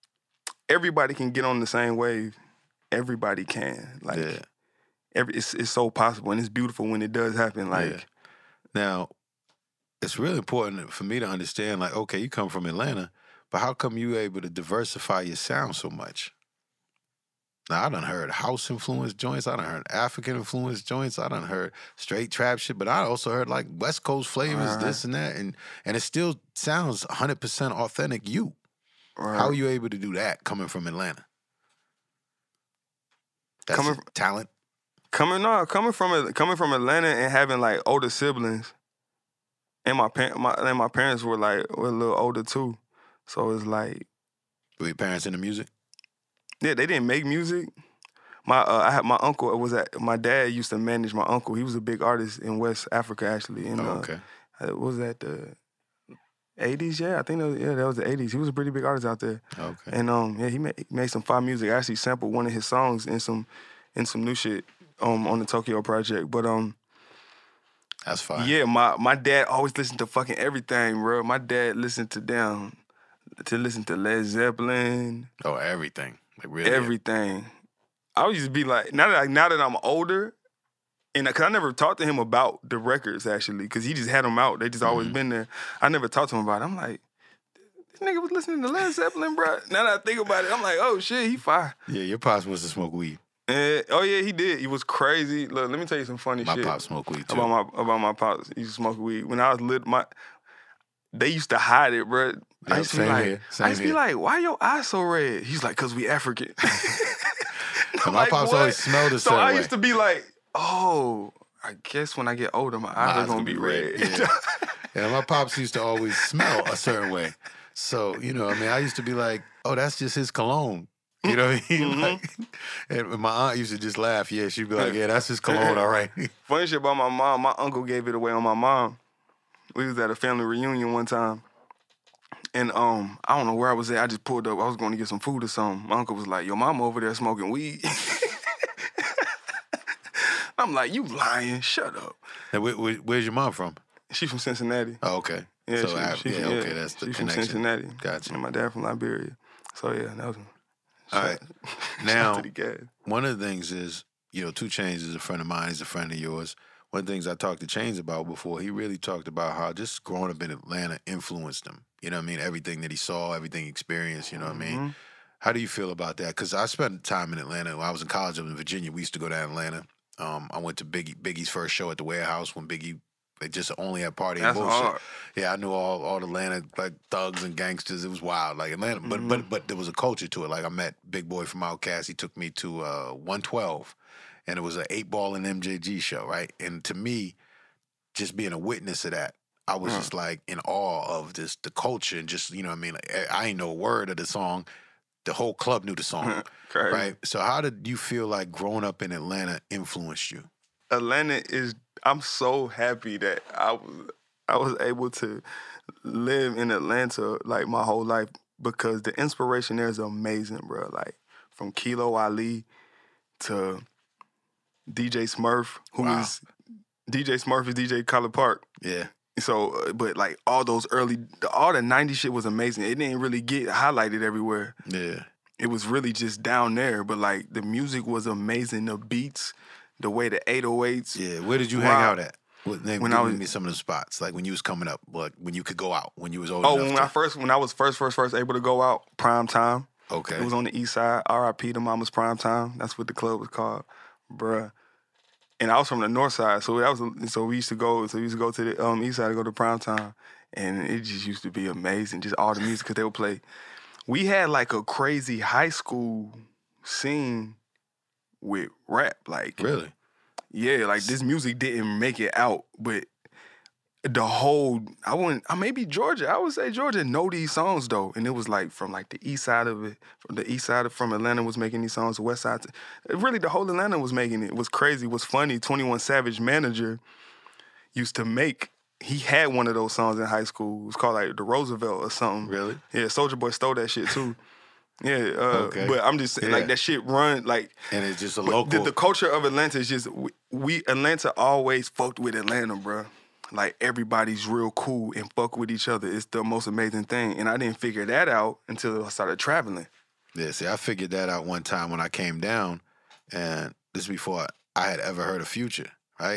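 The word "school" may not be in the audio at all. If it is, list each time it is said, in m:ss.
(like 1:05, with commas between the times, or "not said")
4:15, 4:40.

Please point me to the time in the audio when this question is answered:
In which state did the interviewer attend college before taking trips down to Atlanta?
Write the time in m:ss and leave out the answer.
2:48.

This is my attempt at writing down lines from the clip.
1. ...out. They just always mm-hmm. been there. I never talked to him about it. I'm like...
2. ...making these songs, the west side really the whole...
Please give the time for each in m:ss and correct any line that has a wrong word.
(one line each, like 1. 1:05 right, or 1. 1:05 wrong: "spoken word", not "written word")
1. 1:24 right
2. 4:31 right.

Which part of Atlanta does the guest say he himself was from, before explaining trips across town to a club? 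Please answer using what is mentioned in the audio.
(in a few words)
North side.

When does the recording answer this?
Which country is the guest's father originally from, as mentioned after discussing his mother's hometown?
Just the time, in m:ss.
2:28.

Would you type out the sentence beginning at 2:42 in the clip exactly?
Everything that he saw, everything he experienced, you know what mm-hmm.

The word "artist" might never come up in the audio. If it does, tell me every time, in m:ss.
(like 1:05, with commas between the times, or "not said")
0:52, 0:58.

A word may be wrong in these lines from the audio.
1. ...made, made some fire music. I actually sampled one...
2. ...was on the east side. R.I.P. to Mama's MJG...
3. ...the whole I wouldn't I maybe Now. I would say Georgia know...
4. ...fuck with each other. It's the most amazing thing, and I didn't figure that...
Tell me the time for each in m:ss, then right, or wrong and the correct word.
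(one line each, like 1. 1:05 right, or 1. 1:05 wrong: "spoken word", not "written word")
1. 1:00 right
2. 4:00 wrong: "Prime", not "MJG"
3. 4:24 wrong: "Georgia", not "Now"
4. 4:55 right.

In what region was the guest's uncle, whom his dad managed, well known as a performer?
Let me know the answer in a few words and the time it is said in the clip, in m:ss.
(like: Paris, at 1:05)
West Africa, at 0:52.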